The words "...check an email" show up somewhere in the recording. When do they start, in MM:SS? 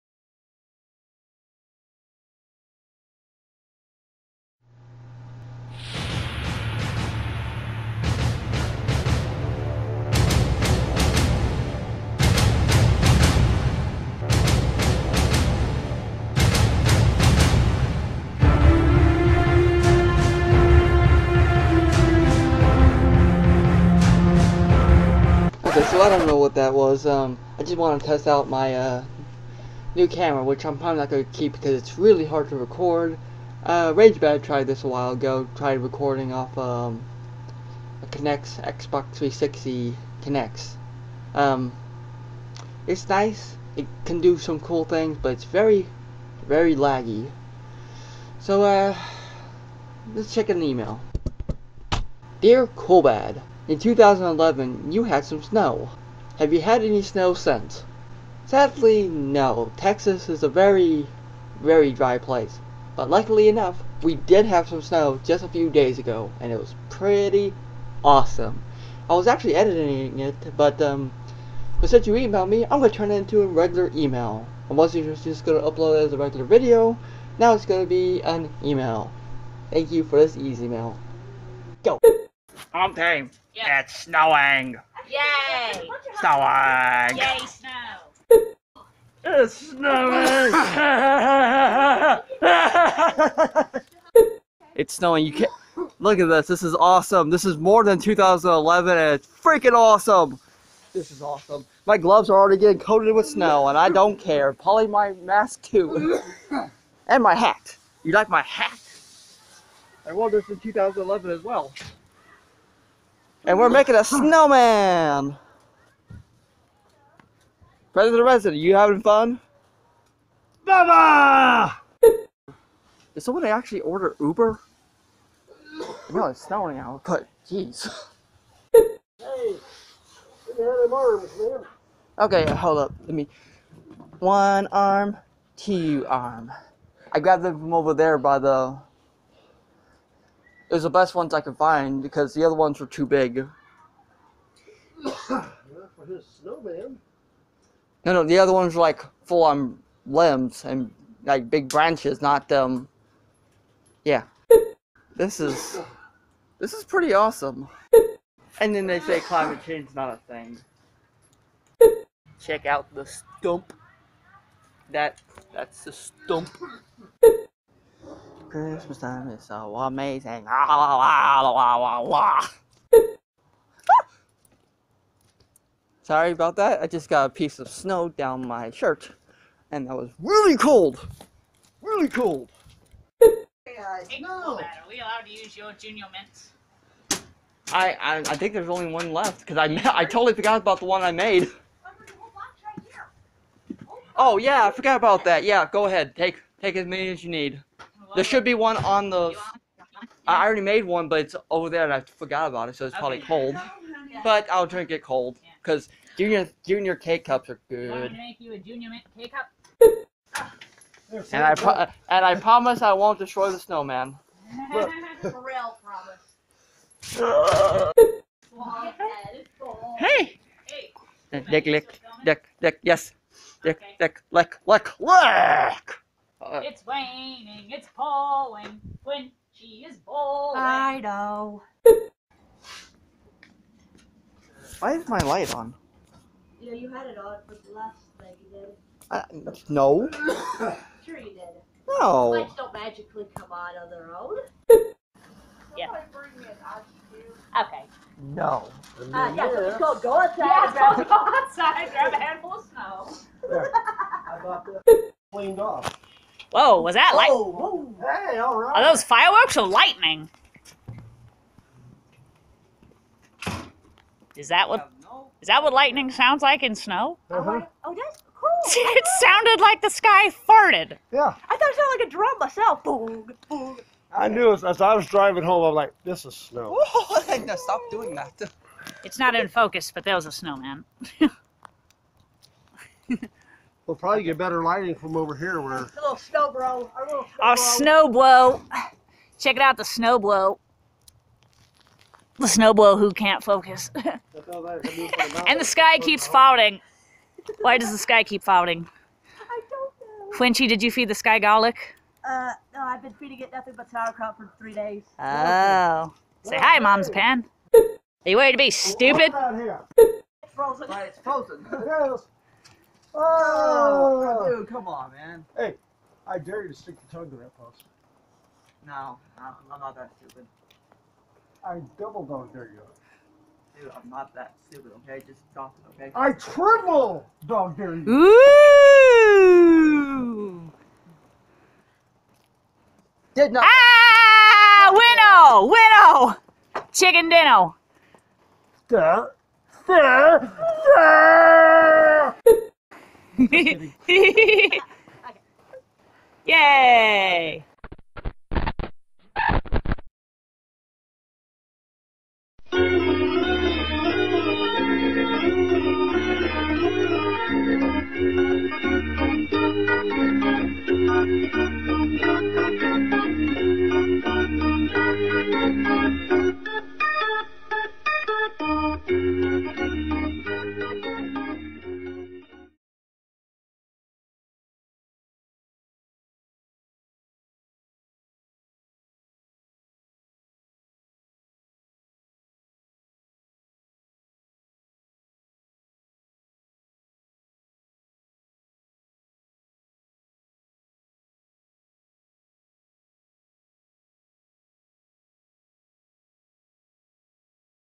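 00:50.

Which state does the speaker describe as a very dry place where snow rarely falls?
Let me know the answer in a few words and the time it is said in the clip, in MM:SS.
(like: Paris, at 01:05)
Texas, at 00:59.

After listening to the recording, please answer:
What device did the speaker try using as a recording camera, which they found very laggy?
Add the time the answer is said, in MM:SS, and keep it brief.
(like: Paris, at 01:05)
Xbox 360 Kinect, at 00:38.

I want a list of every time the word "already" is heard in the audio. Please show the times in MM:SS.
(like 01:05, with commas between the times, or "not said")
01:42, 03:20.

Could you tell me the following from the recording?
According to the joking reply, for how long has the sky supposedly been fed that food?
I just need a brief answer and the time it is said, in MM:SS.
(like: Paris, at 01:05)
3 days, at 05:04.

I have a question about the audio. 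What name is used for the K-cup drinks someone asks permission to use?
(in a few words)
Junior Mints.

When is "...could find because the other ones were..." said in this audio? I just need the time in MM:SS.
02:21.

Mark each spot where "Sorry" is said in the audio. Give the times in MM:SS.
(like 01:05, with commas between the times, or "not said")
02:56.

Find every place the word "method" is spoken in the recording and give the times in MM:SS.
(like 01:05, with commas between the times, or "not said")
not said.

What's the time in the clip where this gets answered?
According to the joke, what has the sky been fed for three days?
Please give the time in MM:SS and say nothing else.
05:03.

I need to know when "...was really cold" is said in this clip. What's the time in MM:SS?
02:59.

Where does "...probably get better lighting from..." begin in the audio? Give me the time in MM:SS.
04:43.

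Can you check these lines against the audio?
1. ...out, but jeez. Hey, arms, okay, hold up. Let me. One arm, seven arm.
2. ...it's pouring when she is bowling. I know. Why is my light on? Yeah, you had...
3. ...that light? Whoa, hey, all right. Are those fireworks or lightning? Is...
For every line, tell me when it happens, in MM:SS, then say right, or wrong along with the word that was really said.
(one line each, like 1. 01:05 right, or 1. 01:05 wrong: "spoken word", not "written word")
1. 02:06 wrong: "two", not "seven"
2. 03:47 right
3. 04:16 right.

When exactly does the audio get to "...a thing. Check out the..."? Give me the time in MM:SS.
02:40.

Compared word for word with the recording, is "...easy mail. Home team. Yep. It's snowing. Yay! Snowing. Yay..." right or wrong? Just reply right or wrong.
right.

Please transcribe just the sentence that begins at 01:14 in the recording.
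I was just gonna upload it as a regular video.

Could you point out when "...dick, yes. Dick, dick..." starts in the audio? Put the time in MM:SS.
03:42.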